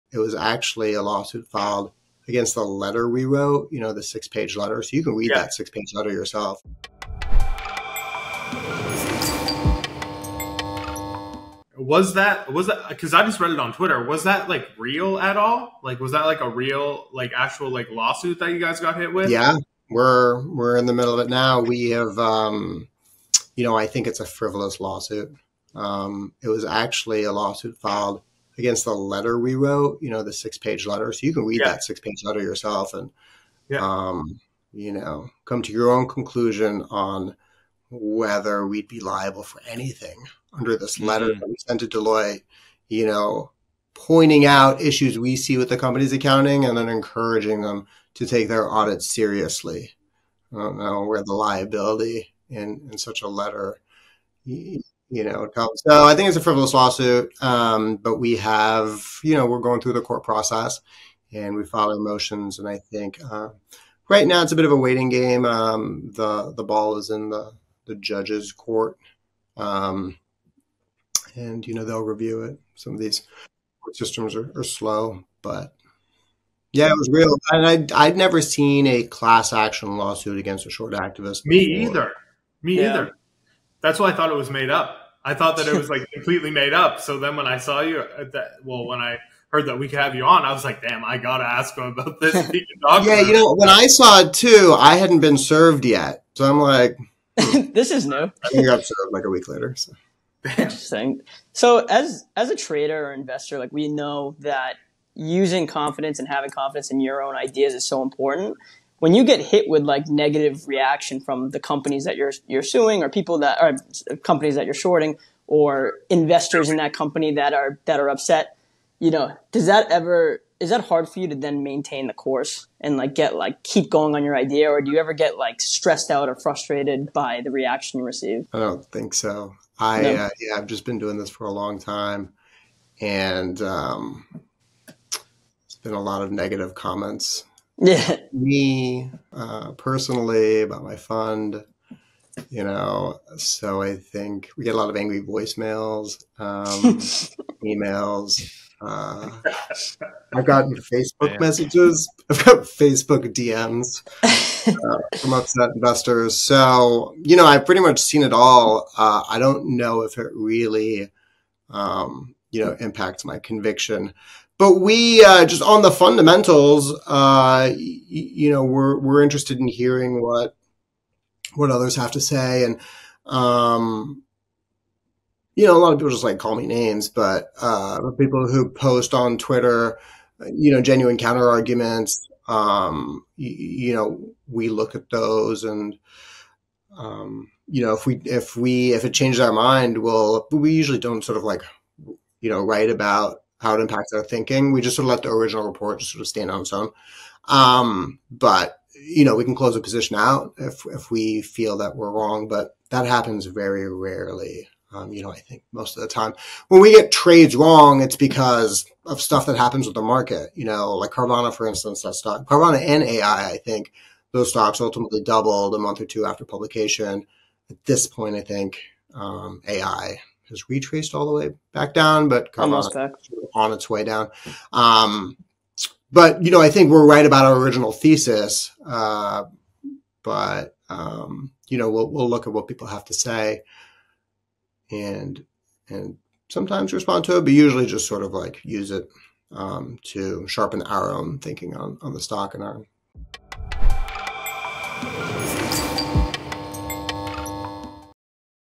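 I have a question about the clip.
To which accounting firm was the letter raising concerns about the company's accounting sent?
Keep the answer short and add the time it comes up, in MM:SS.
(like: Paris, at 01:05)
Deloitte, at 00:41.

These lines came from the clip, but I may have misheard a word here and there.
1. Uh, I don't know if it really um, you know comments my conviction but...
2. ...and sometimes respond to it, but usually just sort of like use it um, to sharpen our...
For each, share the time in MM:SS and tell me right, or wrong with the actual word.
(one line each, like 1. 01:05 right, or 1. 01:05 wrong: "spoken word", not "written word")
1. 02:38 wrong: "impacts", not "comments"
2. 03:55 right.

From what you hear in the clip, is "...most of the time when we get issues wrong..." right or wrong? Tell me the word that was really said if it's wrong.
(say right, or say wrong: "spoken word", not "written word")
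wrong: "trades", not "issues".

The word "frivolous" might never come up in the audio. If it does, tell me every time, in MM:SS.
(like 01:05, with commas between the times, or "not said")
00:24, 00:56.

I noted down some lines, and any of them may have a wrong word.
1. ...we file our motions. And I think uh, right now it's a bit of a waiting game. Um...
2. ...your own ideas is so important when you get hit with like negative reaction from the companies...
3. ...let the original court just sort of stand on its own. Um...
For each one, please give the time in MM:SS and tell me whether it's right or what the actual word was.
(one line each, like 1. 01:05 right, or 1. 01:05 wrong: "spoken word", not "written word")
1. 01:01 right
2. 01:46 right
3. 03:15 wrong: "report", not "court".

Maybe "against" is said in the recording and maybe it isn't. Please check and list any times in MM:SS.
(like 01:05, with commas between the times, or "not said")
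00:02, 00:28, 01:20.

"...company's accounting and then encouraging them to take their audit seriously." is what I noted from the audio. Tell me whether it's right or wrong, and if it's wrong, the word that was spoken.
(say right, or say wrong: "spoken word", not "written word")
right.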